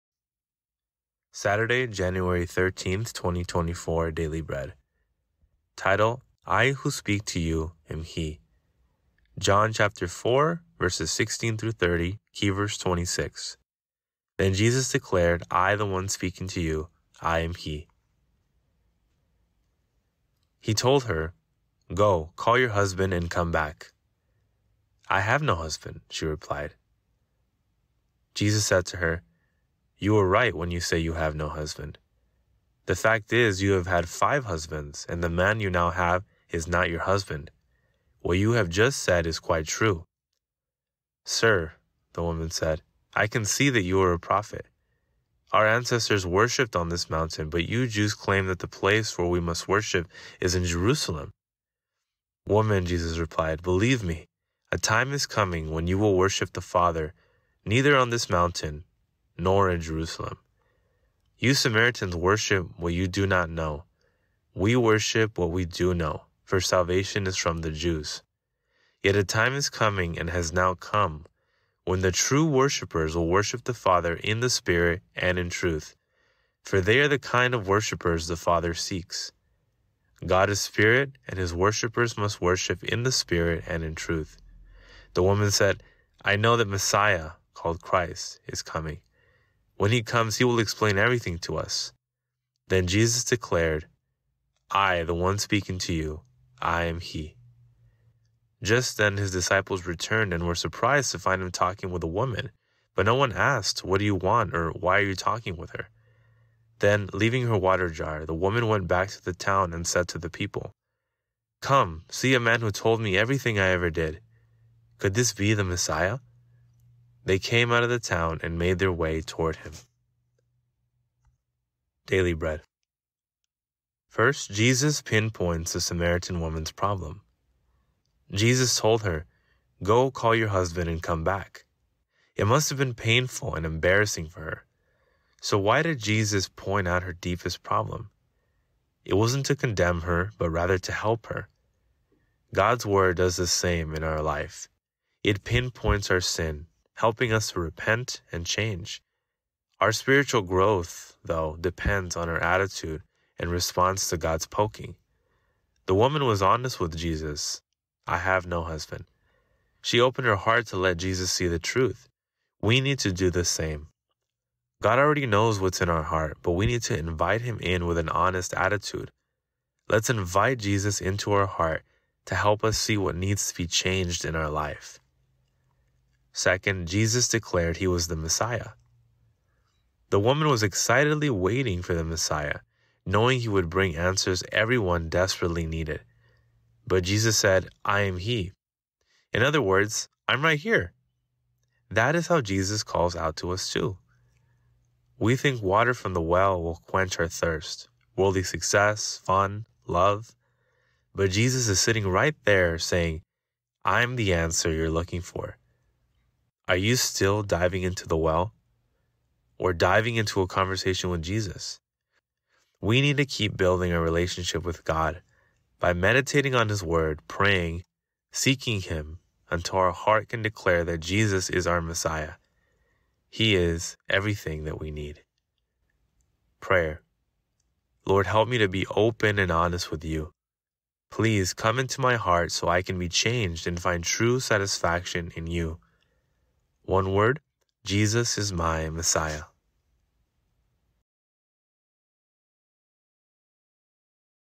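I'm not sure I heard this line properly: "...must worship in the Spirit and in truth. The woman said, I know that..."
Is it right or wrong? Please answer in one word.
right.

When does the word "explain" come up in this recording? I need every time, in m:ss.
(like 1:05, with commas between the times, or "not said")
1:30.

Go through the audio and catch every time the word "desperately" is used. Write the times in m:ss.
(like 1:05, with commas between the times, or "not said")
3:05.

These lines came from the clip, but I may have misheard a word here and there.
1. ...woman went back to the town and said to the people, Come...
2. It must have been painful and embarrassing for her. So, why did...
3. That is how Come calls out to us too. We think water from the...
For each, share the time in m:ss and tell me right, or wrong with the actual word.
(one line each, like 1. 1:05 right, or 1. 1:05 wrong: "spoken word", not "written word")
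1. 1:48 right
2. 2:12 right
3. 3:11 wrong: "Jesus", not "Come".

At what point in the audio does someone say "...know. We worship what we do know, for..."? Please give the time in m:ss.
1:03.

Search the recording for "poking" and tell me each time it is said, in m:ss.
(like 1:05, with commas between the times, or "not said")
2:34.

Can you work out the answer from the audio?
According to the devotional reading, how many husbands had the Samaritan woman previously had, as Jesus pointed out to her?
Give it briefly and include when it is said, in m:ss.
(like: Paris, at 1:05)
5, at 0:34.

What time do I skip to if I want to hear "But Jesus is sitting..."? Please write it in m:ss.
3:21.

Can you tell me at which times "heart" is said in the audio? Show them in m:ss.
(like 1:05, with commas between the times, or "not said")
2:40, 2:46, 2:51, 3:39, 3:52.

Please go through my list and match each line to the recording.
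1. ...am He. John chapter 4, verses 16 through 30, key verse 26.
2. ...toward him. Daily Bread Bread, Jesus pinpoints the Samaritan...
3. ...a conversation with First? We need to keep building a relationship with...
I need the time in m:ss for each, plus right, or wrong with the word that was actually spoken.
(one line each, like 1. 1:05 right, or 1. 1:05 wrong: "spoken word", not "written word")
1. 0:07 right
2. 1:59 wrong: "First", not "Bread"
3. 3:30 wrong: "Jesus", not "First".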